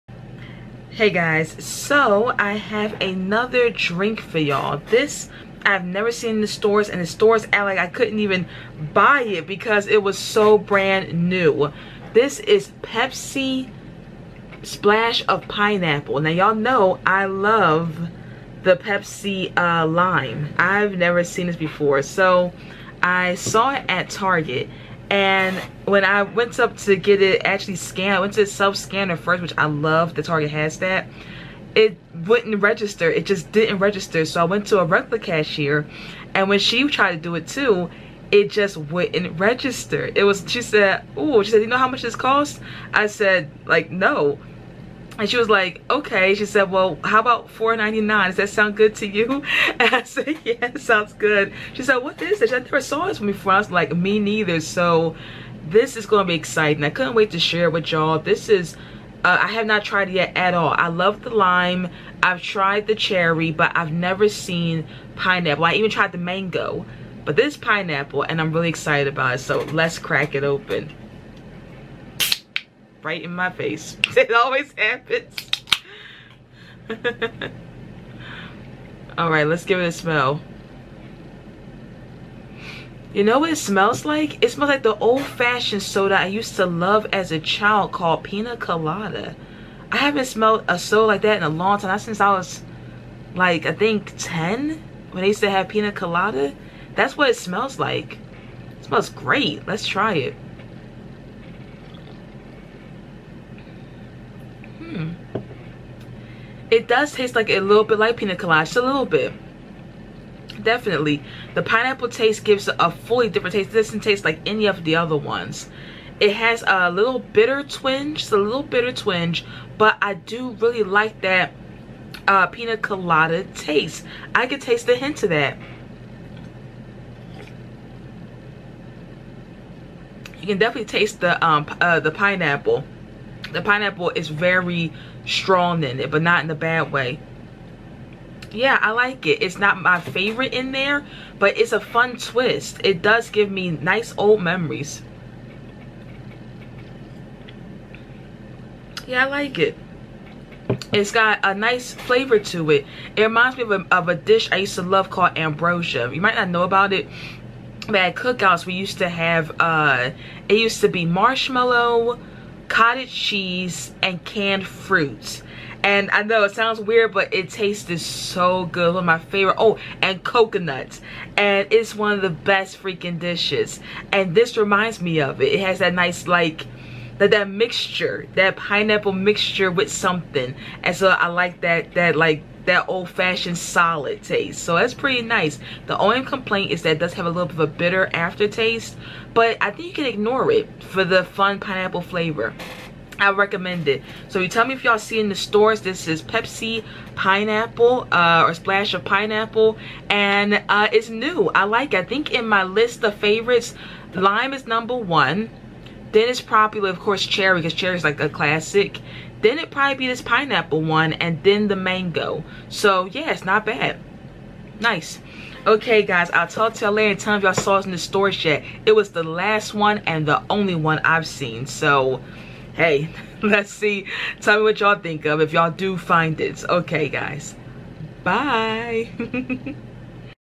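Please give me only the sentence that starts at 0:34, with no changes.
So I went to a regular cashier and when she tried to do it too, it just wouldn't register.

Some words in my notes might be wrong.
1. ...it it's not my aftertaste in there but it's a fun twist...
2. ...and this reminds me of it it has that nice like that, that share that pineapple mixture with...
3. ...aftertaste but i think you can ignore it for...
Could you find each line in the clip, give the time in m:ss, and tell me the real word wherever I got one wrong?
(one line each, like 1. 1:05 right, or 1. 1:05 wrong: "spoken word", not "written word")
1. 2:19 wrong: "favorite", not "aftertaste"
2. 2:54 wrong: "mixture", not "share"
3. 3:08 right.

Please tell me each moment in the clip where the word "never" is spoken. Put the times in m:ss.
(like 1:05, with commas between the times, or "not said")
0:05, 0:20, 0:52, 1:03.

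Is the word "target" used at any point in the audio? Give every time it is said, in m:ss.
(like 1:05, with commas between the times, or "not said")
0:24, 0:30.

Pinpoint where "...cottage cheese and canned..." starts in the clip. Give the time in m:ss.
2:42.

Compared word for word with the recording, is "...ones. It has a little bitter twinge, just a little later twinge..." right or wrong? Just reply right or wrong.
wrong.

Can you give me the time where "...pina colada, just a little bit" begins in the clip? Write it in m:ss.
1:48.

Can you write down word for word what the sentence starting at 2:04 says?
I could taste a hint of that.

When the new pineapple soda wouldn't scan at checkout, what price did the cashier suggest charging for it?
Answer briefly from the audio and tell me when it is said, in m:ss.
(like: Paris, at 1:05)
$4.99, at 0:47.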